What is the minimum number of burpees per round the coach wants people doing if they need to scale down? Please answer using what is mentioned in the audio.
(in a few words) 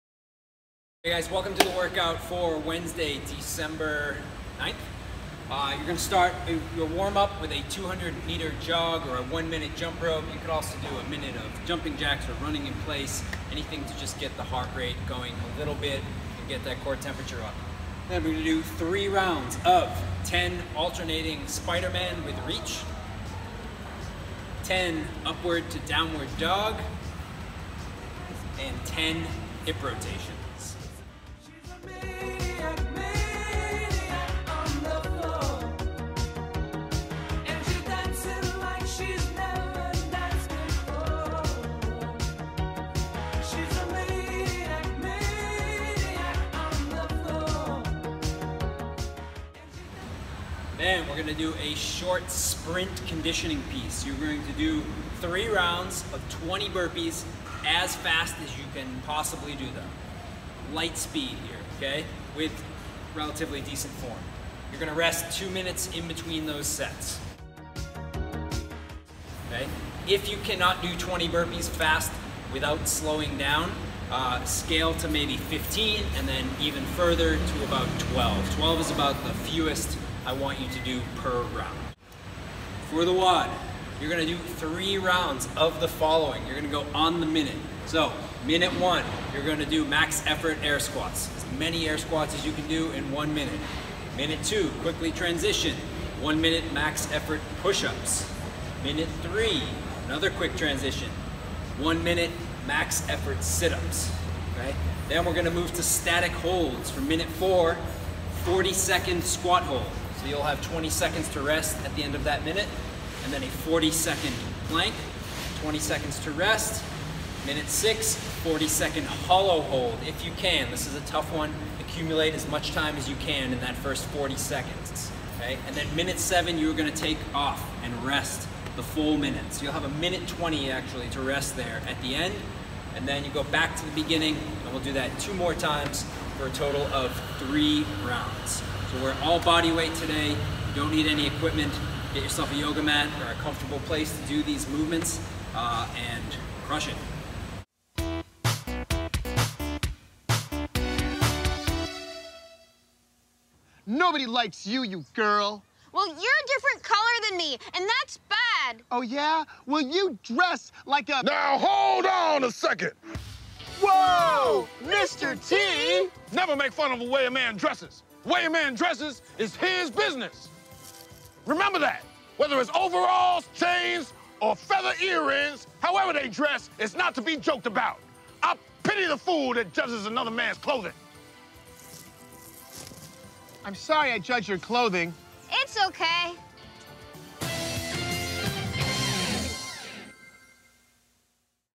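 12.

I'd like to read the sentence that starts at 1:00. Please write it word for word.
light speed here, okay, with relatively decent form.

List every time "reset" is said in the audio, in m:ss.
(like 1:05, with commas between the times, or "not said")
not said.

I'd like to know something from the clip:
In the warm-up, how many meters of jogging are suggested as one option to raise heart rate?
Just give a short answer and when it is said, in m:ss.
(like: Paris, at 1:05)
200, at 0:07.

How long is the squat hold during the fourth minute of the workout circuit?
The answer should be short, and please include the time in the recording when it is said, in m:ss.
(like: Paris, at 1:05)
40 seconds, at 1:48.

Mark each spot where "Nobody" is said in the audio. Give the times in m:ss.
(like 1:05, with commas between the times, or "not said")
2:33.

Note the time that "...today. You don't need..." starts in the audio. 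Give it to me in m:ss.
2:19.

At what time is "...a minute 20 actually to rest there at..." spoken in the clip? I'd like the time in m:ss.
2:09.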